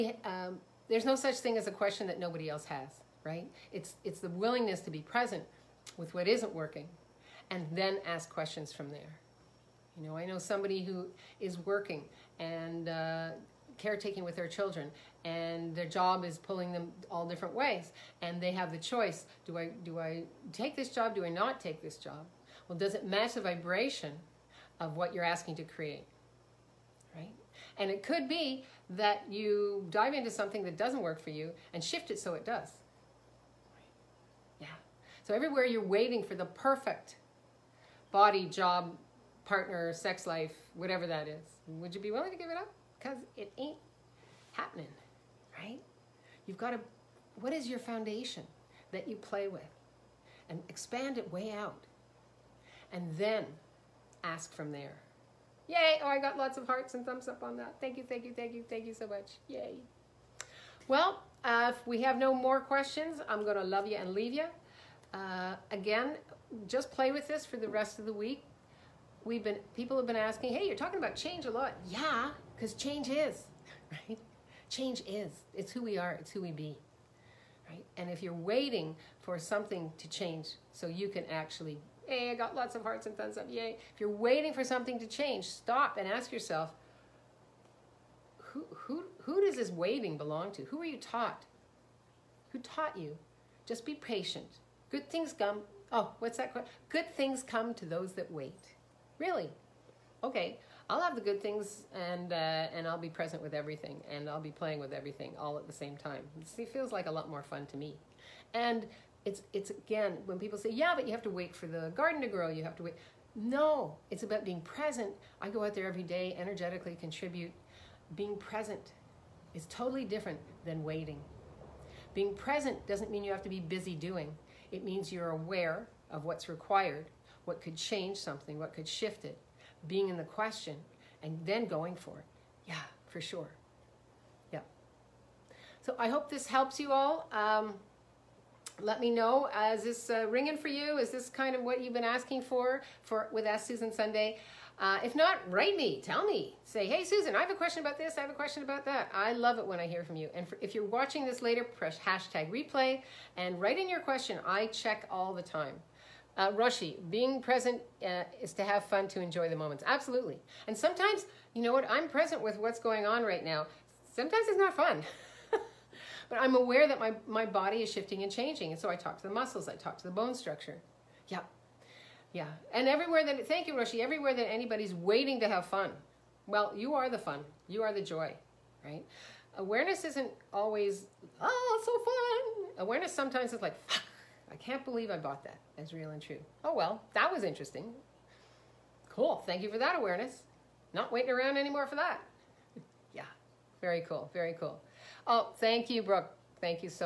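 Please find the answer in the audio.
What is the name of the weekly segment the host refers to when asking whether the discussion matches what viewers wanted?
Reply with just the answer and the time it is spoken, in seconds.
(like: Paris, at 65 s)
Ask Susan Sunday, at 143 s.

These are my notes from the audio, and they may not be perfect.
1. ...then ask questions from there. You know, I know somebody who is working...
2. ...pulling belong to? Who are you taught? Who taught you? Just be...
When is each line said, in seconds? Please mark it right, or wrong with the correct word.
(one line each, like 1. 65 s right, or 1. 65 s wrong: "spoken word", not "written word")
1. 7 s right
2. 89 s wrong: "waiting", not "pulling".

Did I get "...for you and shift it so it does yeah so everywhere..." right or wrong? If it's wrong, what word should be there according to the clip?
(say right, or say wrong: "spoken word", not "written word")
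right.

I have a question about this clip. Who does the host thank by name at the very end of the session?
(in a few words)
Brooke.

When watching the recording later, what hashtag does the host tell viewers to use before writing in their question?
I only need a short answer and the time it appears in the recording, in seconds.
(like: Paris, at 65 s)
replay, at 152 s.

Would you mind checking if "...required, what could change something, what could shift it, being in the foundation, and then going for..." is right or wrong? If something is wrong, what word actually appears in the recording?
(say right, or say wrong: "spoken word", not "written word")
wrong: "question", not "foundation".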